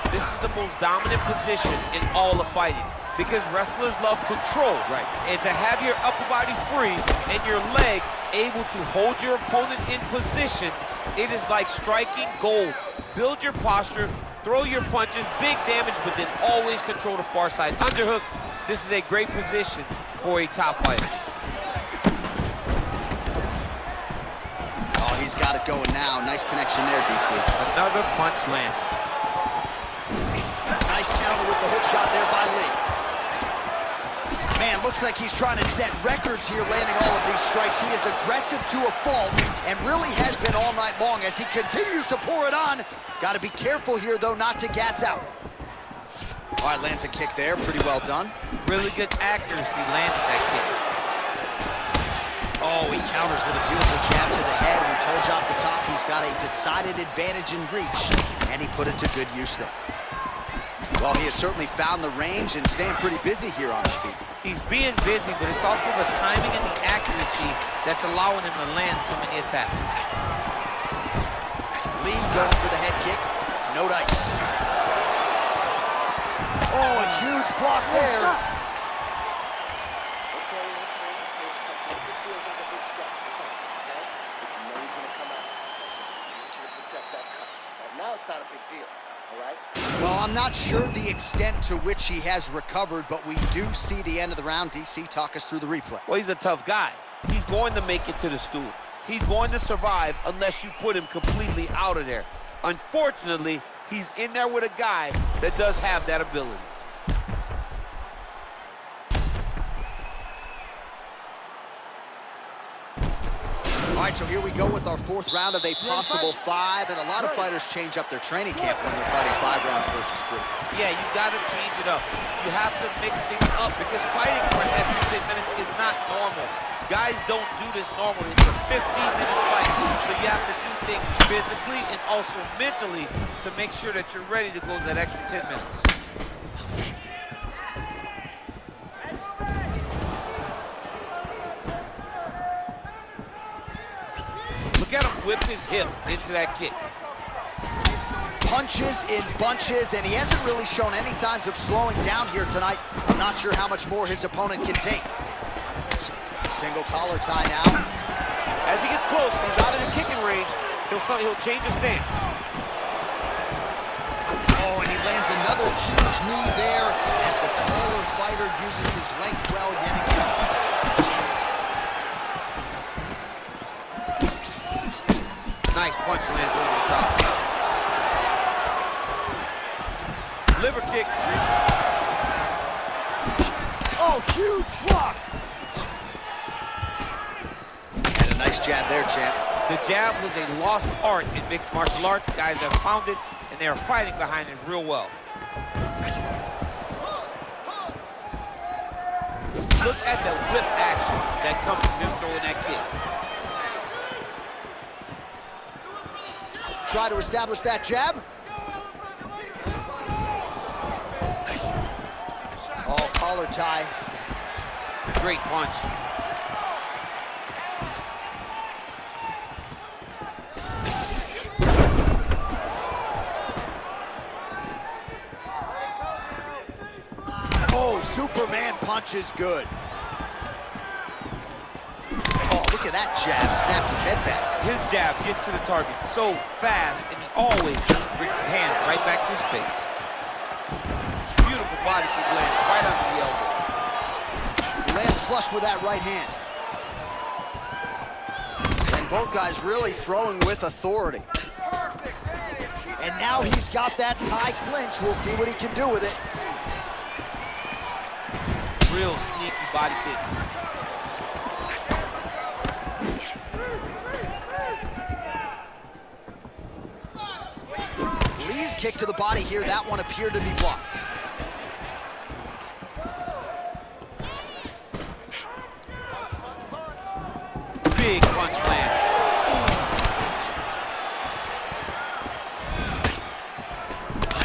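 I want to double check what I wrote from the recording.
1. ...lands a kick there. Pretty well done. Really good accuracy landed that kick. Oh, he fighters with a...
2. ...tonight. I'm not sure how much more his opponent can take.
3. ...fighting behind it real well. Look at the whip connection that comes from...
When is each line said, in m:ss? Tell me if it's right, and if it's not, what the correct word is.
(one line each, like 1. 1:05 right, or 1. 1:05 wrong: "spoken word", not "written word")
1. 0:46 wrong: "counters", not "fighters"
2. 2:32 right
3. 3:13 wrong: "action", not "connection".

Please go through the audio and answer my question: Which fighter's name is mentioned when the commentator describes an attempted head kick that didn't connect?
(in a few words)
Lee.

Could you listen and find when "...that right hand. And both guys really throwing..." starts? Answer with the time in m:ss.
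4:05.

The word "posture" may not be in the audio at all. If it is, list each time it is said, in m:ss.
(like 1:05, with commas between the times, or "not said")
0:13.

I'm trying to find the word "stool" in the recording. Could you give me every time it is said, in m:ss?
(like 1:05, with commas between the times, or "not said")
1:38.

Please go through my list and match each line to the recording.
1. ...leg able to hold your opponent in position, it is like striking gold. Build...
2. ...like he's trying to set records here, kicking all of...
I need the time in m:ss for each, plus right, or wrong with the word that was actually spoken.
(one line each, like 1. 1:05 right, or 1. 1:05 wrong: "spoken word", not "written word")
1. 0:07 right
2. 0:35 wrong: "landing", not "kicking".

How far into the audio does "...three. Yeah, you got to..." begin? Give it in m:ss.
2:00.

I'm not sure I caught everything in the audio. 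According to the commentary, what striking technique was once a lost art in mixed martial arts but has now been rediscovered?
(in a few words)
The jab.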